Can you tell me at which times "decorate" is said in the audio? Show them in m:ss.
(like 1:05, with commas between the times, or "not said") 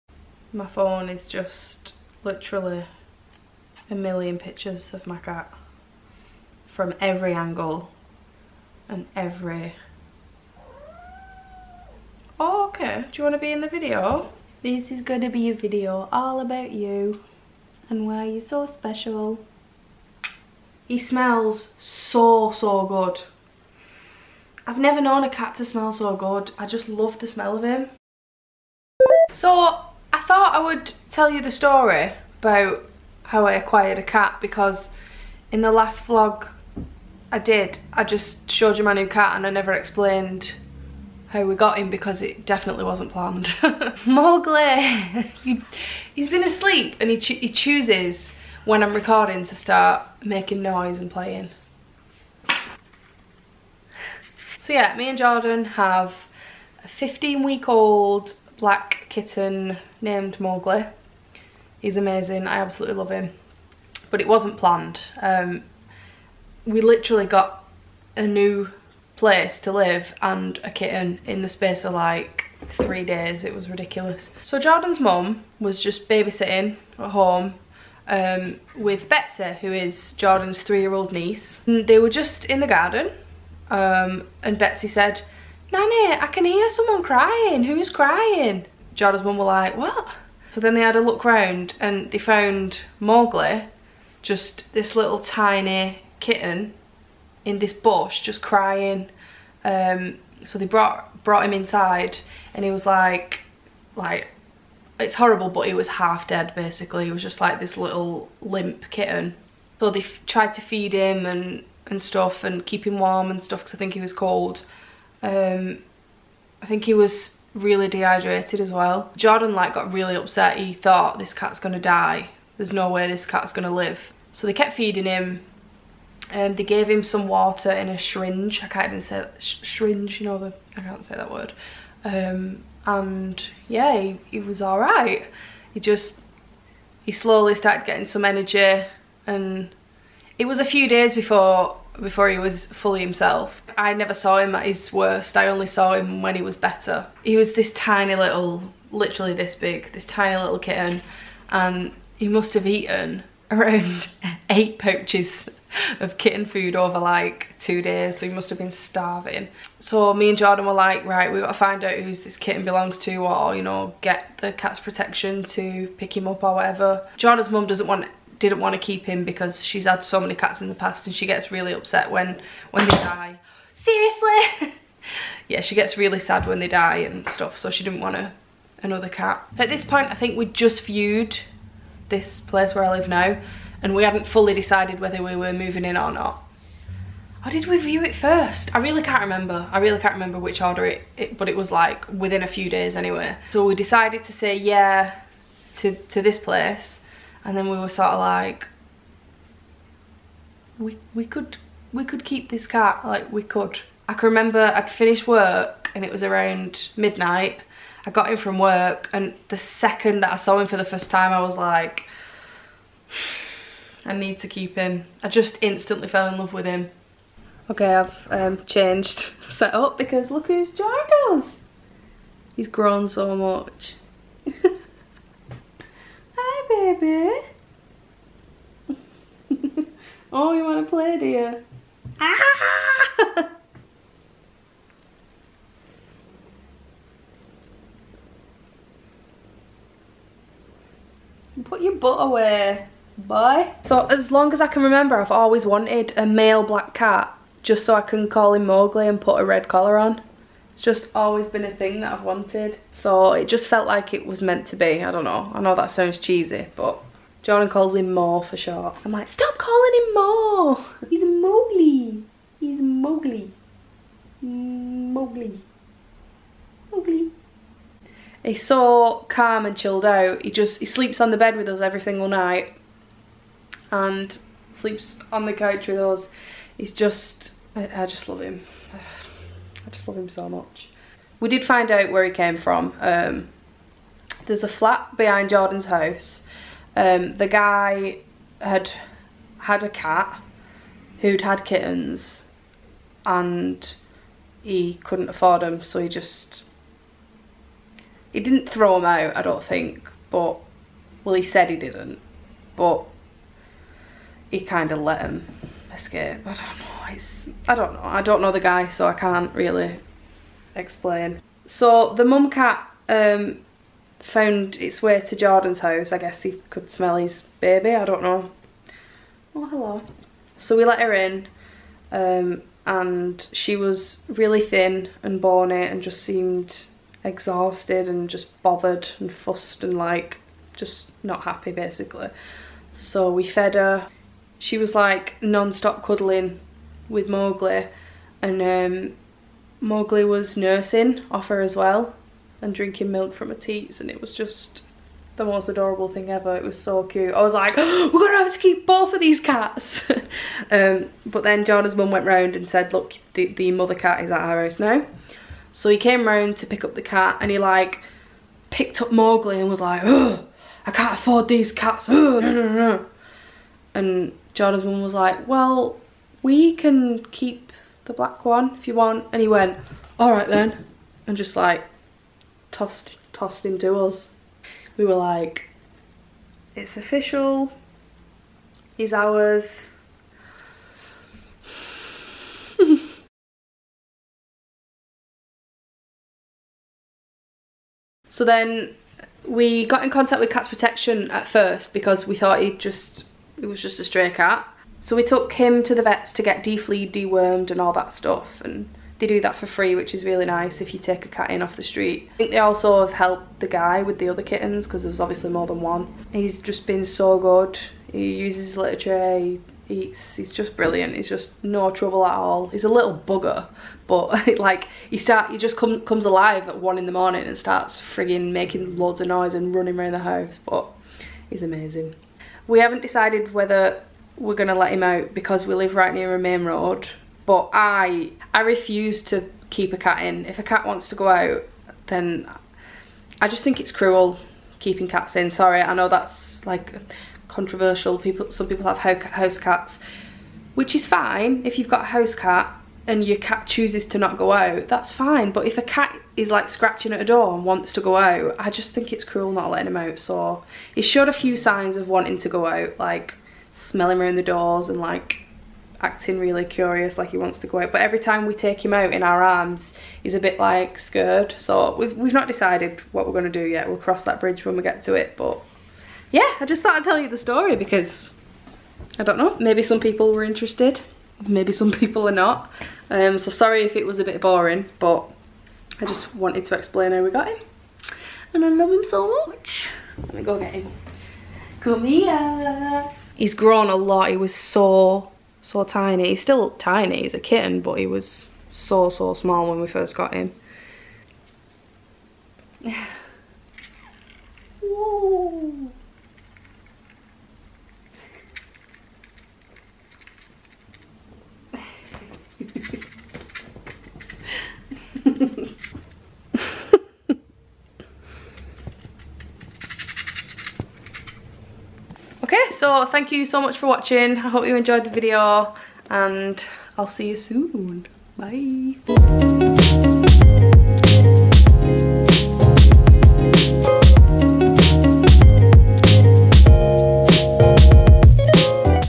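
not said.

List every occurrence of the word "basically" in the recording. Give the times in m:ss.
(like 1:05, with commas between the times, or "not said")
1:46, 5:31.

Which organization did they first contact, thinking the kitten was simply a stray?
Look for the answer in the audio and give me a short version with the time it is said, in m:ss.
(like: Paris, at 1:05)
Cats Protection, at 6:30.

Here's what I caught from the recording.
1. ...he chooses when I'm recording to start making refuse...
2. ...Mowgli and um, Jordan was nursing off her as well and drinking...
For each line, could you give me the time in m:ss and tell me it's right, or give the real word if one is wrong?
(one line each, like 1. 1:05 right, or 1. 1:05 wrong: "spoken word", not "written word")
1. 0:47 wrong: "noise", not "refuse"
2. 5:37 wrong: "Mowgli", not "Jordan".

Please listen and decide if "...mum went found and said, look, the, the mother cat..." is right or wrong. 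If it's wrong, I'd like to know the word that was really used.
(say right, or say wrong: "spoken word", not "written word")
wrong: "round", not "found".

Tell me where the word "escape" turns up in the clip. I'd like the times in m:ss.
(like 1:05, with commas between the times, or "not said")
5:05.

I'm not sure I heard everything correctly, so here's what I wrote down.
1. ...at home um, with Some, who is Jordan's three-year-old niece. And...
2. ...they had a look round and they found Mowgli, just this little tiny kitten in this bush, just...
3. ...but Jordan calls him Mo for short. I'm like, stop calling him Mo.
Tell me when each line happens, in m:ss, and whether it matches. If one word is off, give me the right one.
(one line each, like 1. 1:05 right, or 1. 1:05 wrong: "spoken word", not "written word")
1. 1:16 wrong: "Betsy", not "Some"
2. 1:30 right
3. 4:16 right.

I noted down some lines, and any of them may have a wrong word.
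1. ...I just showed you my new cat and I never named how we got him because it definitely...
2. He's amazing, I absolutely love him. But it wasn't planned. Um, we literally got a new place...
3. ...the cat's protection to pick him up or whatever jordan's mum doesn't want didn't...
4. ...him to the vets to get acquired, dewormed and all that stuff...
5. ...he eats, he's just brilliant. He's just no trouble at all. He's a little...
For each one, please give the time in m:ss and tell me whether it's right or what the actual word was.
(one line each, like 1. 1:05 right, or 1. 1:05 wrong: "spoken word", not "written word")
1. 0:37 wrong: "explained", not "named"
2. 1:01 right
3. 2:44 right
4. 6:35 wrong: "defleed", not "acquired"
5. 6:49 right.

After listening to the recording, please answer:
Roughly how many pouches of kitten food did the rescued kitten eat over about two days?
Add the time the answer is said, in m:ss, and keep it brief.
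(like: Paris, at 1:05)
8, at 2:34.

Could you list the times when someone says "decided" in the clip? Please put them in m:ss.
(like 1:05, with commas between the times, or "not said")
3:04, 3:13, 7:03, 7:42.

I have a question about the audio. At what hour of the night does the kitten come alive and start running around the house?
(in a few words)
1 in the morning.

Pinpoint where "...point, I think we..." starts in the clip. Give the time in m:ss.
2:59.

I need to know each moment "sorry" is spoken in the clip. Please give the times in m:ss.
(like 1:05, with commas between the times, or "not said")
7:15, 7:53.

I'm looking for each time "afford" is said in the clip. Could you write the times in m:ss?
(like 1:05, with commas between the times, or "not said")
4:55, 6:01.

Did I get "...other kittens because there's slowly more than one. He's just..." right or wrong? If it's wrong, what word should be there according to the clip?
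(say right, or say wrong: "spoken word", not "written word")
wrong: "obviously", not "slowly".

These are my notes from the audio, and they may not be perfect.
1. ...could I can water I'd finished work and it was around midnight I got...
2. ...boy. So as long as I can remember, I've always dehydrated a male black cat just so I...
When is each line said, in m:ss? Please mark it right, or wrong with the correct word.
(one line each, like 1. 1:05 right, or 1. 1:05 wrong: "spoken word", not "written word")
1. 3:23 wrong: "remember", not "water"
2. 4:03 wrong: "wanted", not "dehydrated".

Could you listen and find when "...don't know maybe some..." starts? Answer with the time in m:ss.
7:49.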